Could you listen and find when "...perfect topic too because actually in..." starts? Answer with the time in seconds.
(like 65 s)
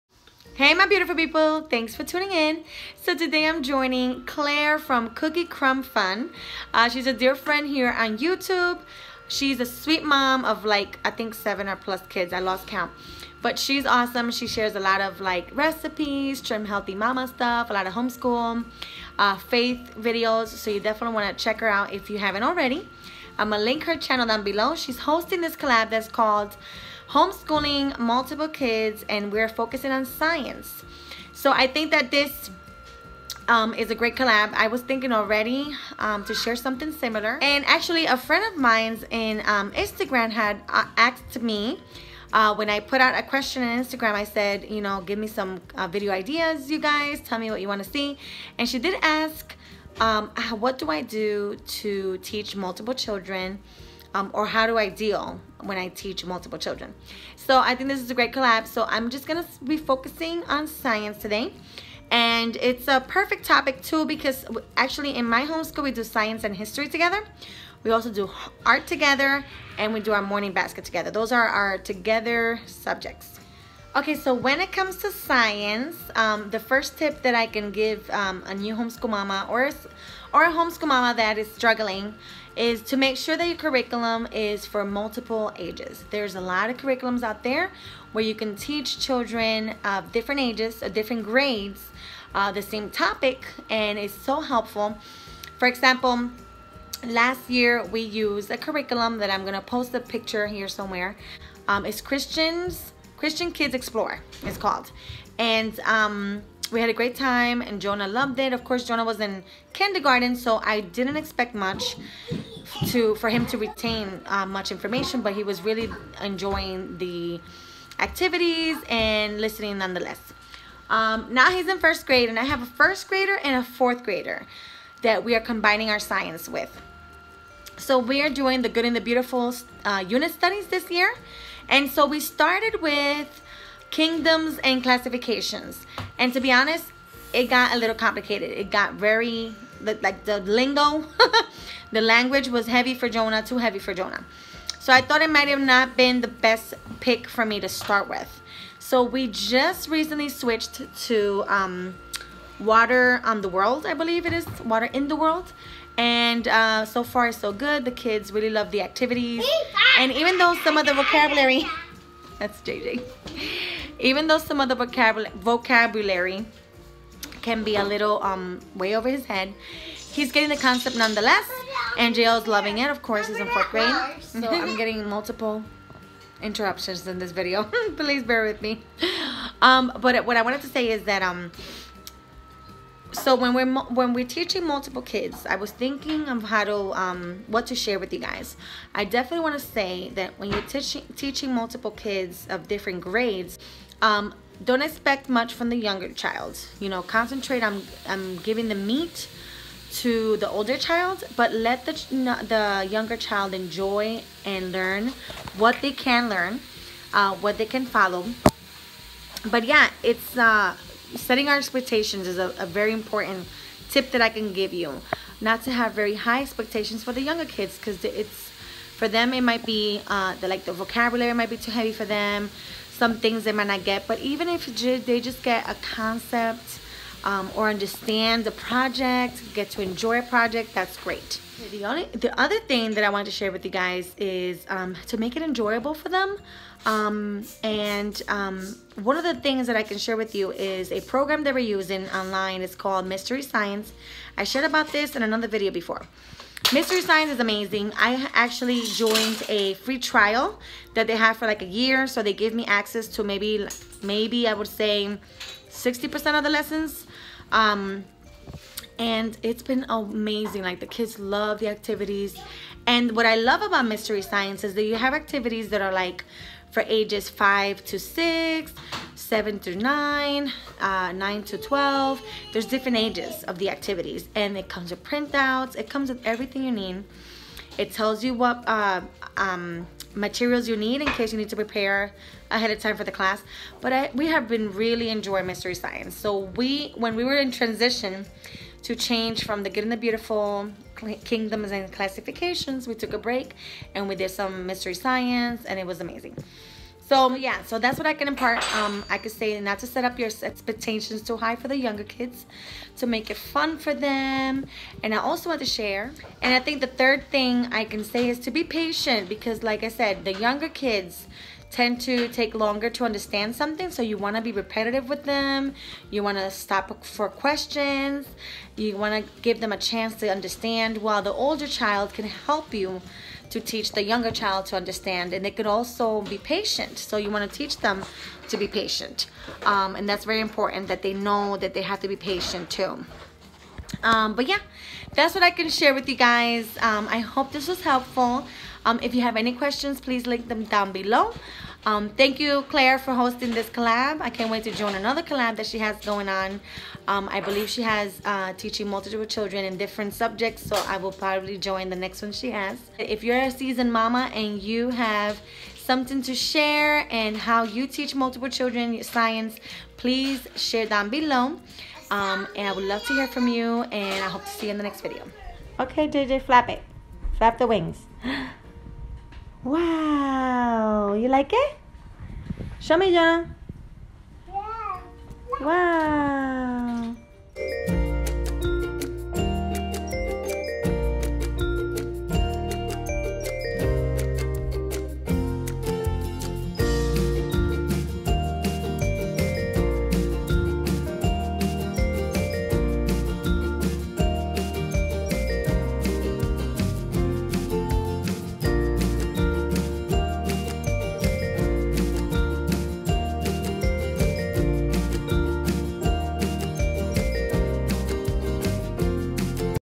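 63 s.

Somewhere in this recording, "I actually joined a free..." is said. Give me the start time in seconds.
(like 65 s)
247 s.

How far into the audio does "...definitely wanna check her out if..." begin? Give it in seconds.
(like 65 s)
20 s.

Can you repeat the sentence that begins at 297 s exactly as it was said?
So yeah, so that's what I can impart.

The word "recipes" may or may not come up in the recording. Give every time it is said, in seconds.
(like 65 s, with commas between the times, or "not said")
15 s.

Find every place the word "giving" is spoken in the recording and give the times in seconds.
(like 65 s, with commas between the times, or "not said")
198 s.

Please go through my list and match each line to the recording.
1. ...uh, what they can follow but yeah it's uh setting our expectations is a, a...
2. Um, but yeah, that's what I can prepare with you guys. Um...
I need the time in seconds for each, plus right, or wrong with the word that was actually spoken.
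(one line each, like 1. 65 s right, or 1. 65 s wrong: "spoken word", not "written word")
1. 207 s right
2. 334 s wrong: "share", not "prepare".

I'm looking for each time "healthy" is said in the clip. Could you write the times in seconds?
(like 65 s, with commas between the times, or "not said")
16 s.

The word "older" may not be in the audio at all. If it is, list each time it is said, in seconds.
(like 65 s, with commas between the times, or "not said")
200 s, 321 s.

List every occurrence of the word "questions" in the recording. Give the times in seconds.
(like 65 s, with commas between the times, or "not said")
43 s, 317 s, 339 s.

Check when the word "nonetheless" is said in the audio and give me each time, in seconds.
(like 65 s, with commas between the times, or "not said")
119 s, 170 s.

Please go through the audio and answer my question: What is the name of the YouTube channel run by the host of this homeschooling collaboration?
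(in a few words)
Cookie Crumb Fun.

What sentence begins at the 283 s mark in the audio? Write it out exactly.
But I, we have been really enjoying Mystery Science.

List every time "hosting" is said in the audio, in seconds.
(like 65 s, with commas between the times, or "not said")
24 s, 343 s.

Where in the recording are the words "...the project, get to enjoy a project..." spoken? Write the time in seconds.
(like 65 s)
228 s.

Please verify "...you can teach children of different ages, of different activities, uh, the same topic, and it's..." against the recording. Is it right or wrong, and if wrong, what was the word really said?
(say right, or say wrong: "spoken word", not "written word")
wrong: "grades", not "activities".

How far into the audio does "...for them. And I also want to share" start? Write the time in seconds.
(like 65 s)
303 s.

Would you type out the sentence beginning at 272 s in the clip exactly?
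There's different ages of the activities.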